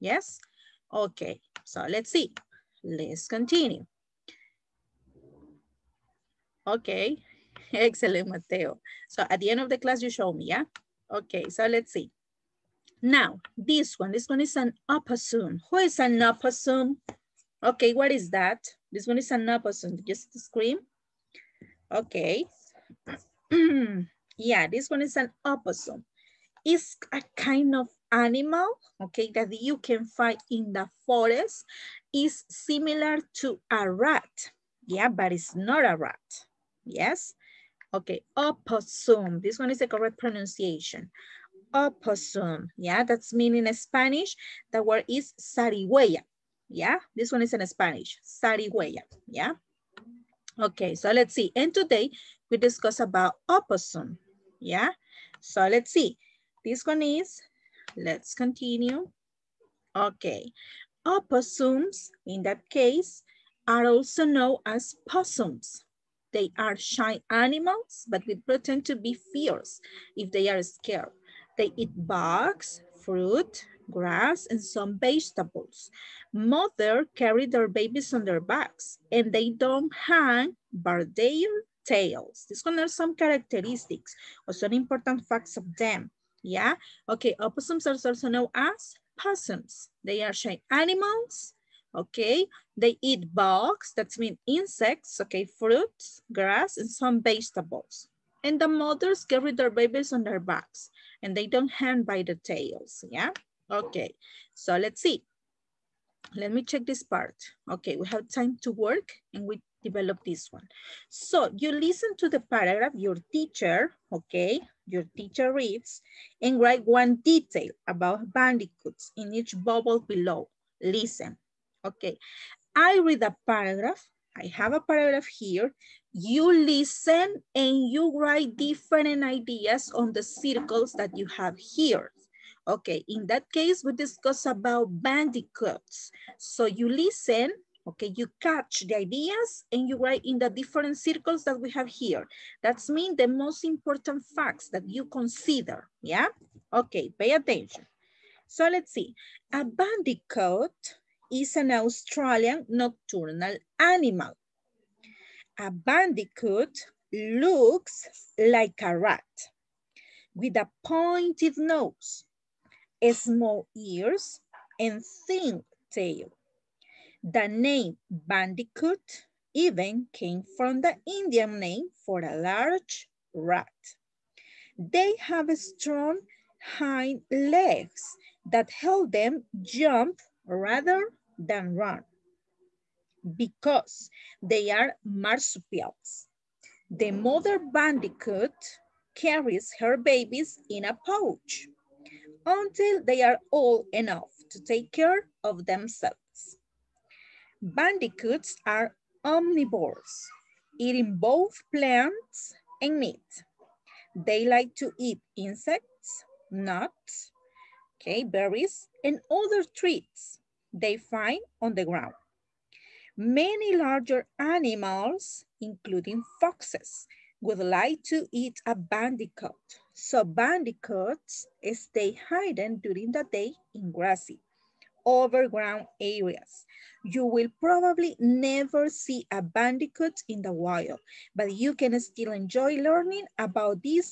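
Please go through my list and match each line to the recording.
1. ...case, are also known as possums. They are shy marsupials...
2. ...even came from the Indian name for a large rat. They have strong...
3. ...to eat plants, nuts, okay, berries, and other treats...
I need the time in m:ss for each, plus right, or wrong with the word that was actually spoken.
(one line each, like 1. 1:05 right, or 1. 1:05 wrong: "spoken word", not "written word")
1. 1:02 wrong: "animals", not "marsupials"
2. 2:49 right
3. 3:24 wrong: "insects", not "plants".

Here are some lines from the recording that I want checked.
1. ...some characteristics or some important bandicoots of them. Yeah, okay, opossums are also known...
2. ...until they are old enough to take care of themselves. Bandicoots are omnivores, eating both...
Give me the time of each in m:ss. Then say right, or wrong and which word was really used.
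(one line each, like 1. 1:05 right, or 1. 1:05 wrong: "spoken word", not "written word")
1. 1:22 wrong: "facts", not "bandicoots"
2. 3:12 right.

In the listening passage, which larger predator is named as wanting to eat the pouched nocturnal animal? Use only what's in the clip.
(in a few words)
foxes.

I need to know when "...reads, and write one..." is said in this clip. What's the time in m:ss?
1:55.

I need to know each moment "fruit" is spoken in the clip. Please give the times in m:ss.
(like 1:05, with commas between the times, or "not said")
1:13, 1:35.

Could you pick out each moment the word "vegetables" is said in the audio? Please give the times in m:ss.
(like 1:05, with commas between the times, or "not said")
1:14, 1:37.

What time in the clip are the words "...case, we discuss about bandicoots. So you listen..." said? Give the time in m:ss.
2:13.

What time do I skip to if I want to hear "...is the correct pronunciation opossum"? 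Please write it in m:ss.
0:39.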